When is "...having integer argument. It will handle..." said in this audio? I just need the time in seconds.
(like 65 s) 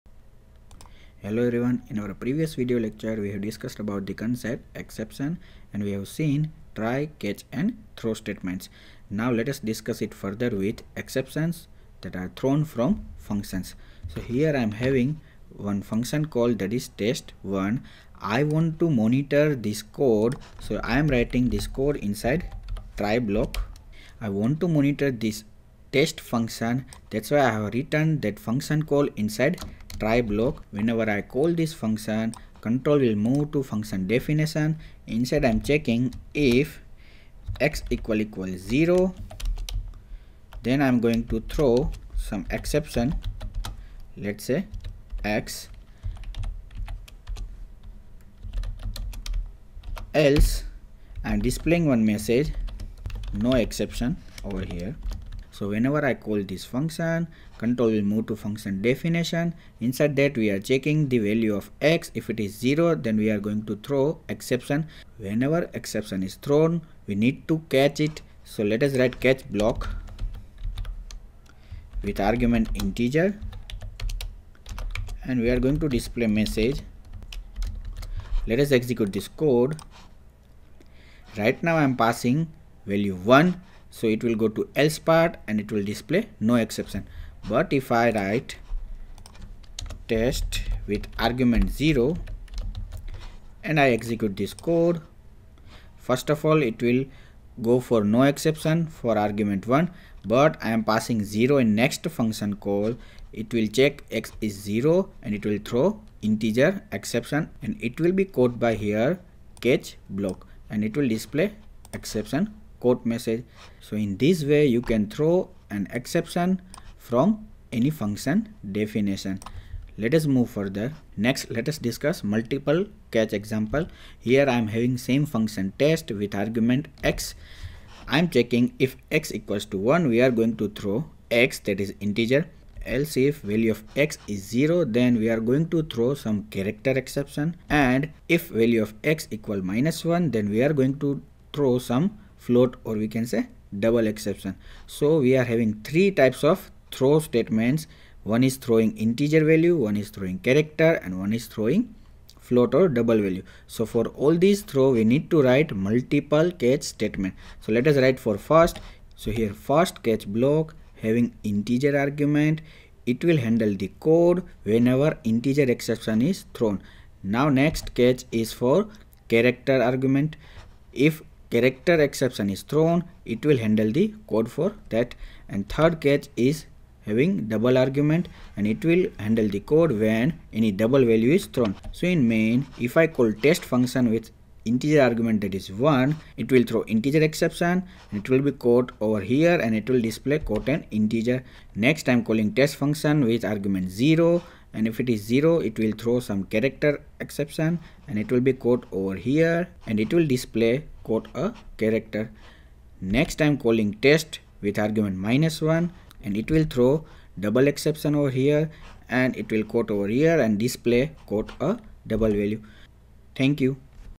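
161 s.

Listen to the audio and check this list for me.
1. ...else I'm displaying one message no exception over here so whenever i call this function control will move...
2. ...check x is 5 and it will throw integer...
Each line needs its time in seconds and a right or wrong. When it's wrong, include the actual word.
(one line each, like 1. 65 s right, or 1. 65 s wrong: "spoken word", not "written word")
1. 50 s right
2. 103 s wrong: "0", not "5".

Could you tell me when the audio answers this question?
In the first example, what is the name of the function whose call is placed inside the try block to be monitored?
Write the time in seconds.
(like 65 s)
16 s.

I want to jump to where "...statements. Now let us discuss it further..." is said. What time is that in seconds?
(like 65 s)
8 s.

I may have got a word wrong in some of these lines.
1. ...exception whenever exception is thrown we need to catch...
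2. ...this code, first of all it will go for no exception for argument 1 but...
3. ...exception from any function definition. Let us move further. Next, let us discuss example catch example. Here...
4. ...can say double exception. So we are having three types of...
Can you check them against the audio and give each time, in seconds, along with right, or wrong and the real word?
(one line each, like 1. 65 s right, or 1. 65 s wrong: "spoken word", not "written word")
1. 64 s right
2. 94 s right
3. 115 s wrong: "multiple", not "example"
4. 143 s right.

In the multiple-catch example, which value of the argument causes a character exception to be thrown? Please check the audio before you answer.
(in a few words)
0.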